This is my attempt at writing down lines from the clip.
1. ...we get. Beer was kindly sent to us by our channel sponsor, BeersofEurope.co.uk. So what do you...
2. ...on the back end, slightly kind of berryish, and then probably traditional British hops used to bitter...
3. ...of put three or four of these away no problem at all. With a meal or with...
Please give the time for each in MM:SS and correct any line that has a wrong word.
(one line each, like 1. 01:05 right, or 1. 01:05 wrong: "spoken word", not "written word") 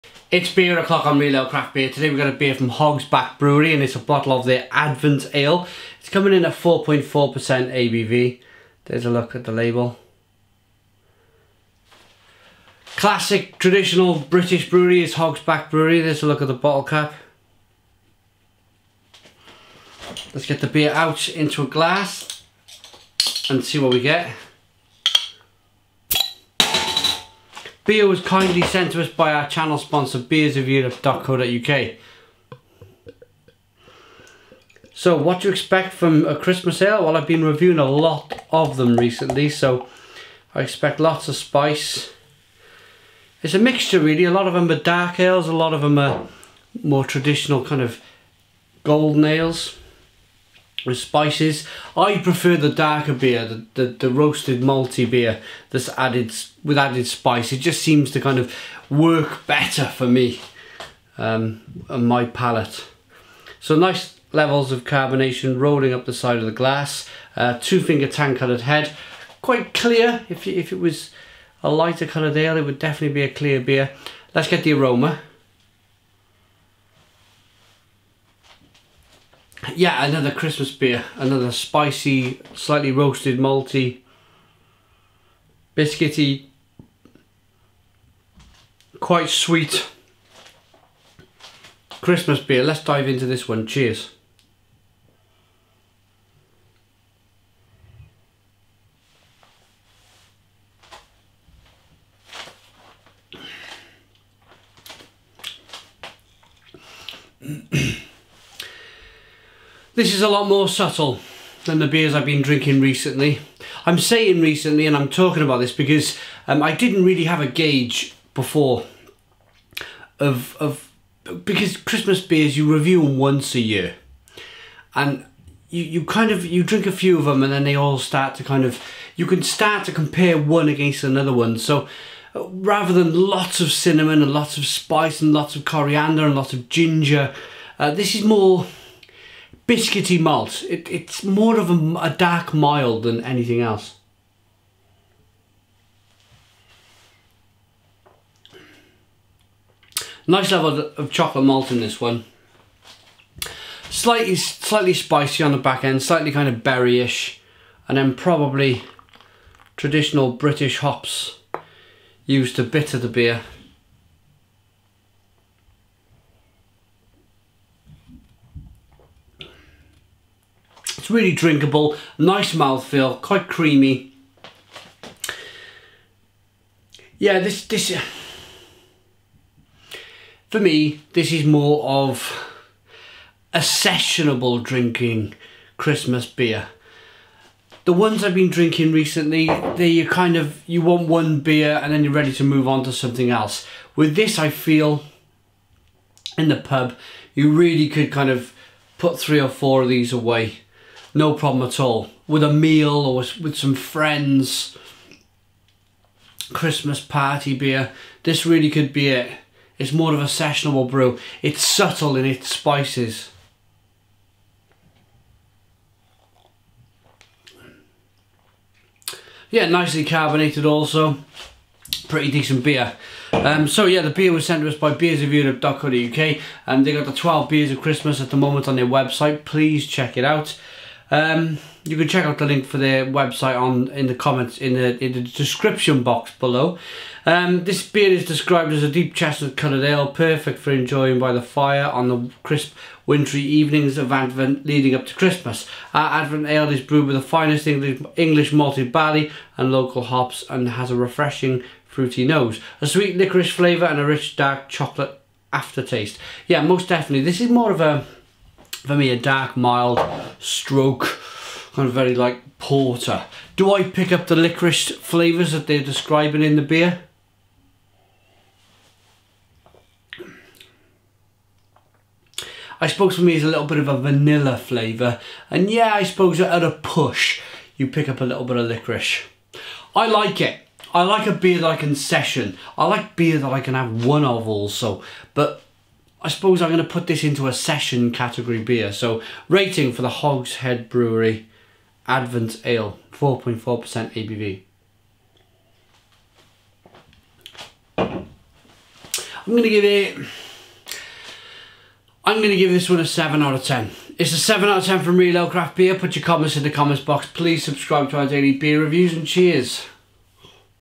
1. 00:23 right
2. 02:35 right
3. 03:18 right.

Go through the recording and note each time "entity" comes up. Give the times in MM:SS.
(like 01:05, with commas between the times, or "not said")
not said.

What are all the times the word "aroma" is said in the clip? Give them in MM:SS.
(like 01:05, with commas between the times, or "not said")
01:14.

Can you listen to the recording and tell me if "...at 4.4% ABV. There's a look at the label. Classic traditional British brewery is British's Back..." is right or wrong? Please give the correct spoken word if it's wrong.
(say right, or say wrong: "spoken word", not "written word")
wrong: "Hog", not "British".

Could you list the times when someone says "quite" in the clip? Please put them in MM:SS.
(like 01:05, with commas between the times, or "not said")
01:09, 01:28, 02:53.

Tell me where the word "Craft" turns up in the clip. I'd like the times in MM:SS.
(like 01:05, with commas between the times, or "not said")
00:01, 05:05.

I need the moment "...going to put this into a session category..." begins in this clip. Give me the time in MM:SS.
04:46.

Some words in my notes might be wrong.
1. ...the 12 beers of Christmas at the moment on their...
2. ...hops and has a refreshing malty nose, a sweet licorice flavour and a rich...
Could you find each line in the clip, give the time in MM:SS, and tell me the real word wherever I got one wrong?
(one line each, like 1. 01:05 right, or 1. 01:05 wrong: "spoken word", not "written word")
1. 03:47 right
2. 04:10 wrong: "fruity", not "malty".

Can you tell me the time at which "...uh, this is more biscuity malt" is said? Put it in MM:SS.
02:17.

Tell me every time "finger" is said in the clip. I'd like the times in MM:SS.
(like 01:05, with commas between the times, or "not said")
01:07.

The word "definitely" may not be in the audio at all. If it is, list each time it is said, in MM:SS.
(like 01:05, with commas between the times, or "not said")
01:12, 04:16.